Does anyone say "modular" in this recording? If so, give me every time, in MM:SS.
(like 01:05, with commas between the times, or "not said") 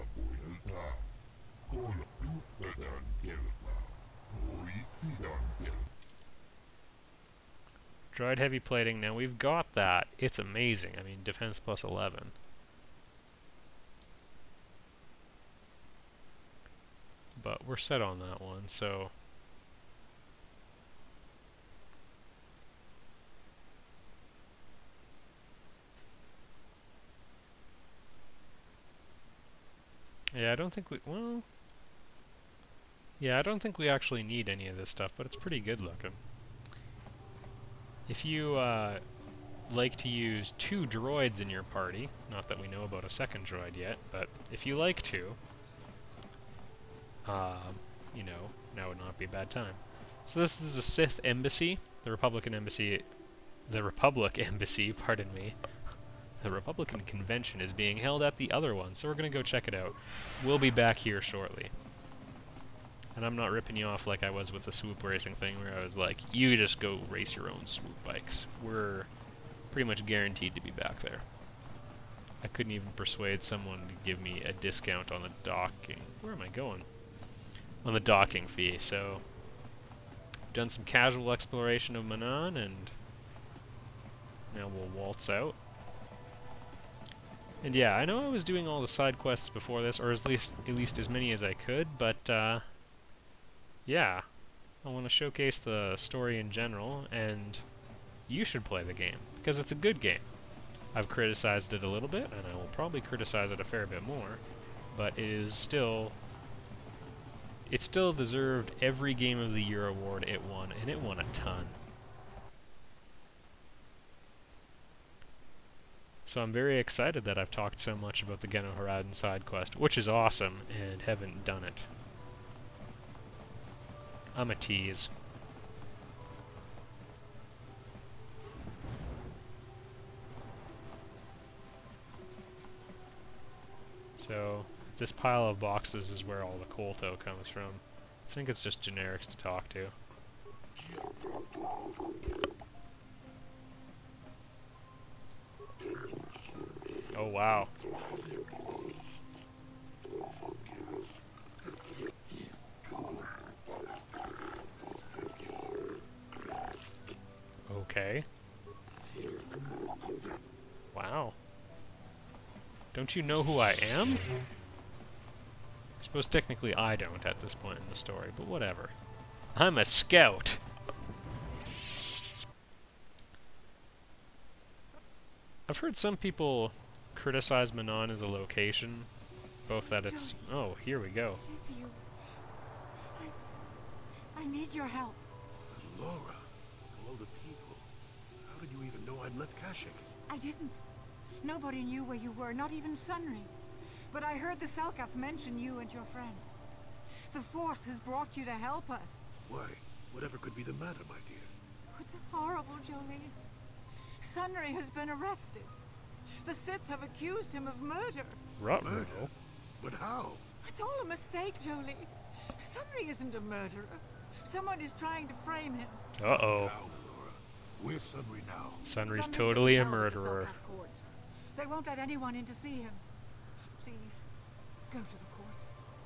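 not said.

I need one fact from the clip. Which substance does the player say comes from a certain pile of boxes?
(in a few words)
Kolto.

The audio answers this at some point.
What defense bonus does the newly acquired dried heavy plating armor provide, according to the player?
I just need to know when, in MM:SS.
00:11.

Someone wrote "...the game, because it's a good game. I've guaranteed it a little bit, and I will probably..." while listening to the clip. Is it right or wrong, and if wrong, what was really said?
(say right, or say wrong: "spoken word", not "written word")
wrong: "criticized", not "guaranteed".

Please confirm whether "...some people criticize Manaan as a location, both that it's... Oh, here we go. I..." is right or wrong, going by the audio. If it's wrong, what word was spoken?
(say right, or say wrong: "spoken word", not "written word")
right.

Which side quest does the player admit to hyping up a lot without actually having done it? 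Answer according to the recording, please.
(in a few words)
Genoharadan.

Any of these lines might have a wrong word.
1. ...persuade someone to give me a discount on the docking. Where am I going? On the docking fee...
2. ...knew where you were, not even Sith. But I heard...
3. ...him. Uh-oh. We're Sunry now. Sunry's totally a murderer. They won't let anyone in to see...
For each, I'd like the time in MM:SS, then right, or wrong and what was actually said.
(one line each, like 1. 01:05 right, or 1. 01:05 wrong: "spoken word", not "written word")
1. 01:12 right
2. 03:11 wrong: "Sunry", not "Sith"
3. 03:35 right.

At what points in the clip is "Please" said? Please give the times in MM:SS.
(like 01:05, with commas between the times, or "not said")
03:43.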